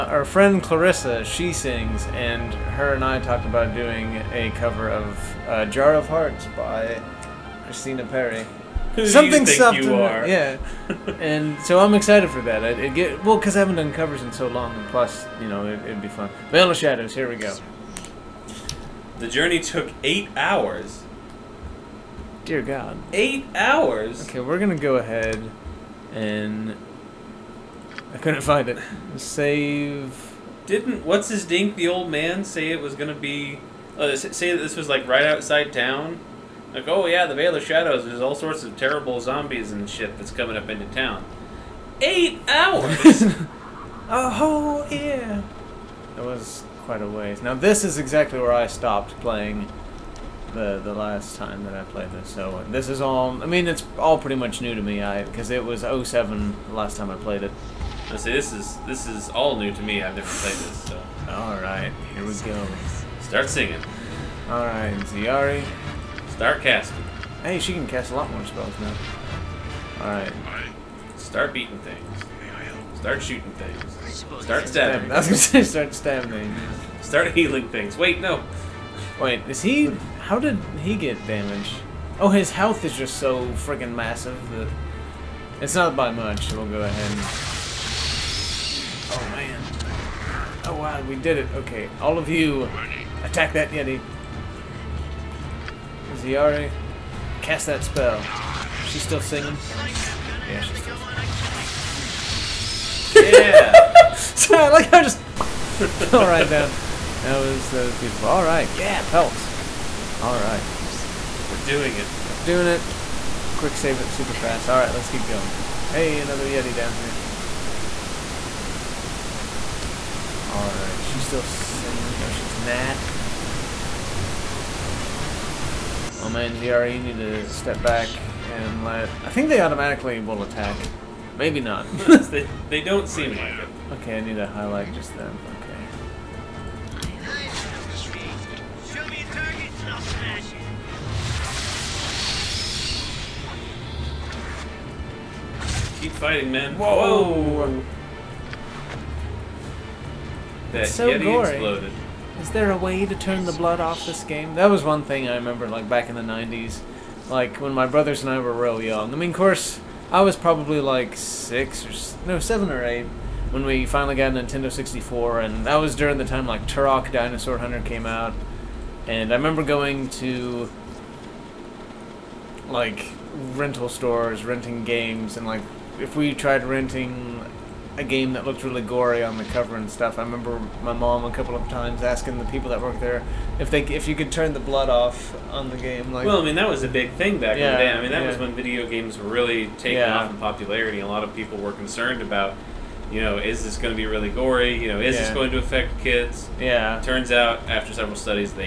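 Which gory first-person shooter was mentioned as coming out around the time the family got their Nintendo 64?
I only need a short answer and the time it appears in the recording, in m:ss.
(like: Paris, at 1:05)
Turok Dinosaur Hunter, at 2:46.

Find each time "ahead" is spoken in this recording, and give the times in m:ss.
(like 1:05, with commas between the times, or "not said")
0:24, 1:26.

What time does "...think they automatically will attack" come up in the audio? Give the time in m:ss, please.
2:09.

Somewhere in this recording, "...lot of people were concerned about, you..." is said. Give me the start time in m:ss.
3:11.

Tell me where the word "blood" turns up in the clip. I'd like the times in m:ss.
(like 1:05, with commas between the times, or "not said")
2:33, 3:04.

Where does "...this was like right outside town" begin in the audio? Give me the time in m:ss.
0:34.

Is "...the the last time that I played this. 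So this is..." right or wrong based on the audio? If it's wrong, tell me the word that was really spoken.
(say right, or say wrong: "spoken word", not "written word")
right.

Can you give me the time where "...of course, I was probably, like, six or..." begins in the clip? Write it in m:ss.
2:39.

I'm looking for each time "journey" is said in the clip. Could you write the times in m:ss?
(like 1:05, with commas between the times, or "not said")
0:19.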